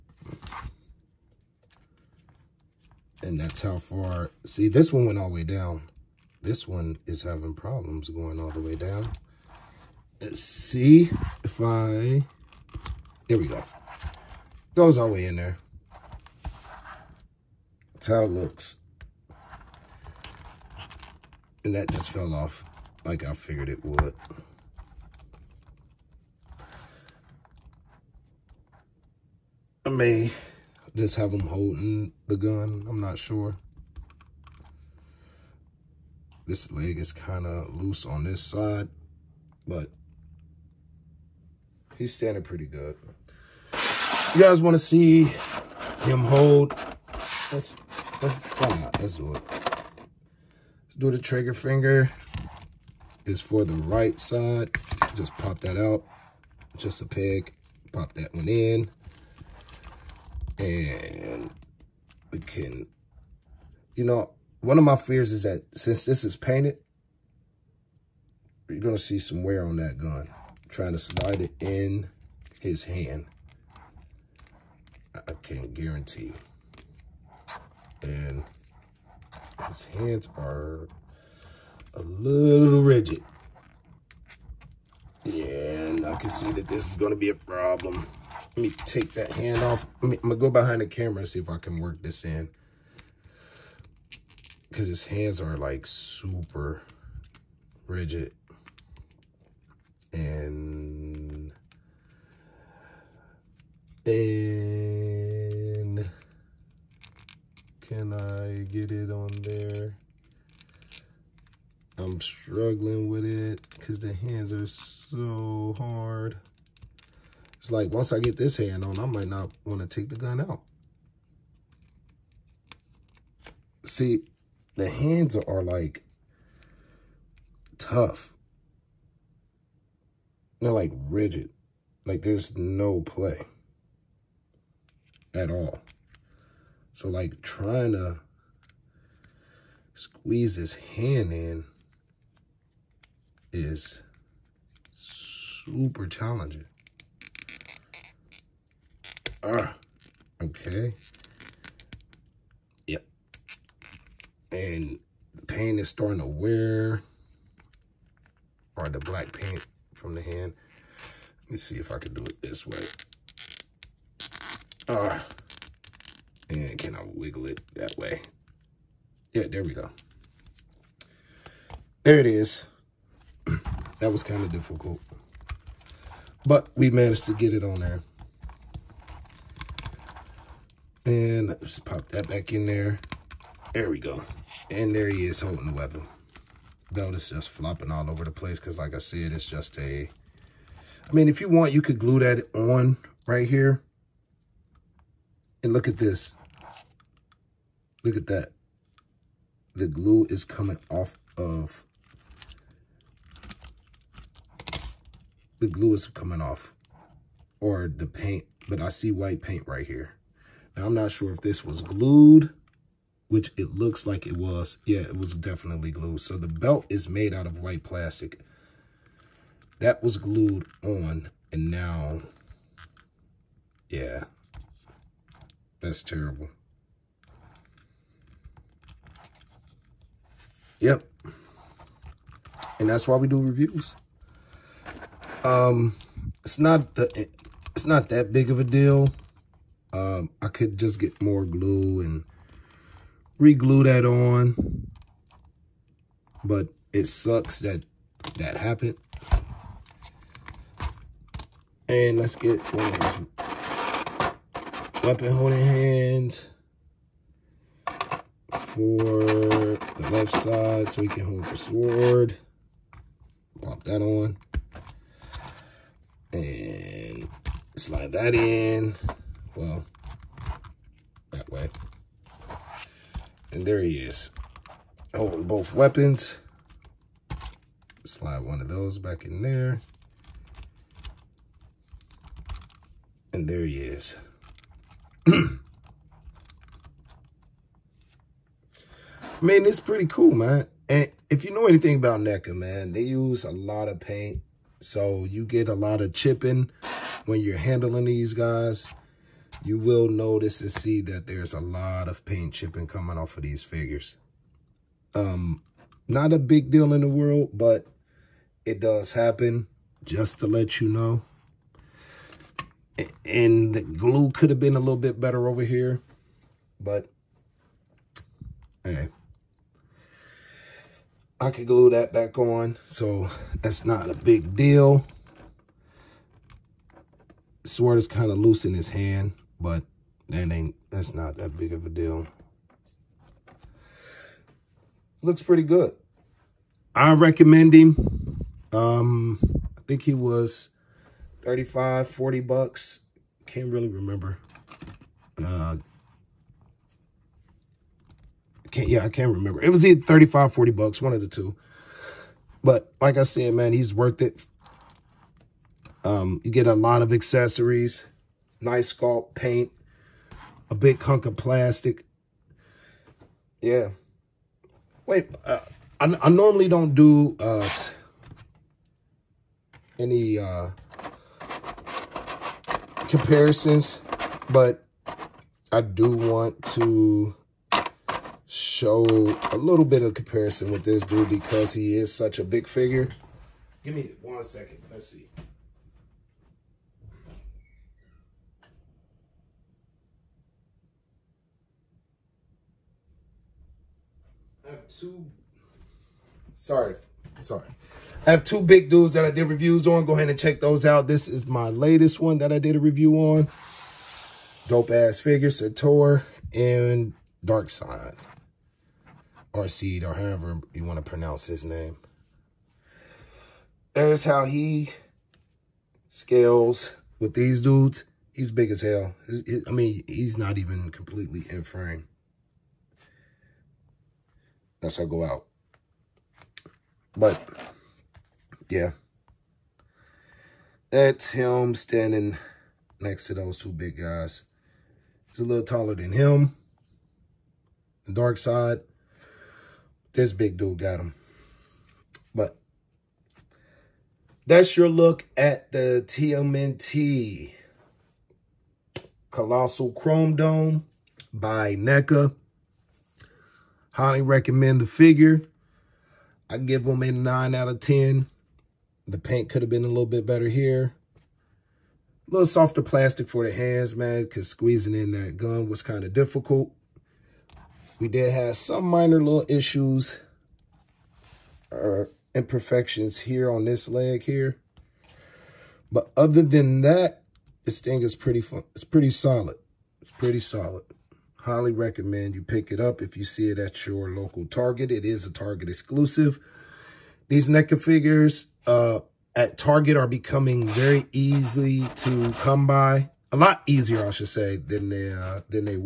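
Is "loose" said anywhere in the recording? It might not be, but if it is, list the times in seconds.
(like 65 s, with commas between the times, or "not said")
37 s, 328 s.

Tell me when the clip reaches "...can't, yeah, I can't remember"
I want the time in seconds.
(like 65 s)
348 s.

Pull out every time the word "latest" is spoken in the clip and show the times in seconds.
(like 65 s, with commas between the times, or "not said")
401 s.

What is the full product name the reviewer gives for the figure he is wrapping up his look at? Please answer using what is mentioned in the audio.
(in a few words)
TMNT Colossal Chrome Dome.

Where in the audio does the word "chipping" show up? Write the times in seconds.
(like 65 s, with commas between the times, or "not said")
296 s, 302 s.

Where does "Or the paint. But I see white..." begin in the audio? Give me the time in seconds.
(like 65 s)
207 s.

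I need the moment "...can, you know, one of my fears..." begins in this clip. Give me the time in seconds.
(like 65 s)
62 s.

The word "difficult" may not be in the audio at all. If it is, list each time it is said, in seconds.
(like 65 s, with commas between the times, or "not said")
174 s, 466 s.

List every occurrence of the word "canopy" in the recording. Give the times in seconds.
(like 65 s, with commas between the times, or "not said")
not said.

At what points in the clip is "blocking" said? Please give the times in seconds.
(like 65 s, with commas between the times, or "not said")
not said.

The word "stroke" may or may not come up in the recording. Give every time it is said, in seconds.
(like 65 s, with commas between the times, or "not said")
not said.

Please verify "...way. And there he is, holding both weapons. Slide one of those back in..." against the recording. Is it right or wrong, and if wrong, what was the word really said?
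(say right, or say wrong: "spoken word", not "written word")
right.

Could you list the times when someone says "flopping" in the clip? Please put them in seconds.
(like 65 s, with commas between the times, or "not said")
187 s.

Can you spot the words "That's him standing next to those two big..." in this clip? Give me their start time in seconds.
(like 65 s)
430 s.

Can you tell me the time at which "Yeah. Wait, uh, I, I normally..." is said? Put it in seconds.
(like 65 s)
363 s.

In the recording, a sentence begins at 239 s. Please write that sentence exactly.
Um, I could just get more glue and reglue that on.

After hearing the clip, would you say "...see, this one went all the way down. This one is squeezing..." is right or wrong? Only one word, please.
wrong.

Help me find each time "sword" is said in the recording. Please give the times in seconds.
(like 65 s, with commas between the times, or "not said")
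261 s, 327 s.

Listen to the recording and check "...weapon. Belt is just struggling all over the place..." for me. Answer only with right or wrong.
wrong.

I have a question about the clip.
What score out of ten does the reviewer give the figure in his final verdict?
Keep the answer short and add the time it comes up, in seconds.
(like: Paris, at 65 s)
9, at 457 s.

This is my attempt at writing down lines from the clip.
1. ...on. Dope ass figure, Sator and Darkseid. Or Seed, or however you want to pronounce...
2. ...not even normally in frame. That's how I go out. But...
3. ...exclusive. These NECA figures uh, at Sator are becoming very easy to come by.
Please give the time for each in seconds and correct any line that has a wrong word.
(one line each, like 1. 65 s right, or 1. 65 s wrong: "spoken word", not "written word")
1. 403 s right
2. 420 s wrong: "completely", not "normally"
3. 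485 s wrong: "Target", not "Sator".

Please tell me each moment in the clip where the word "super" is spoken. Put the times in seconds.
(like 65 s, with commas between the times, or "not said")
95 s, 144 s.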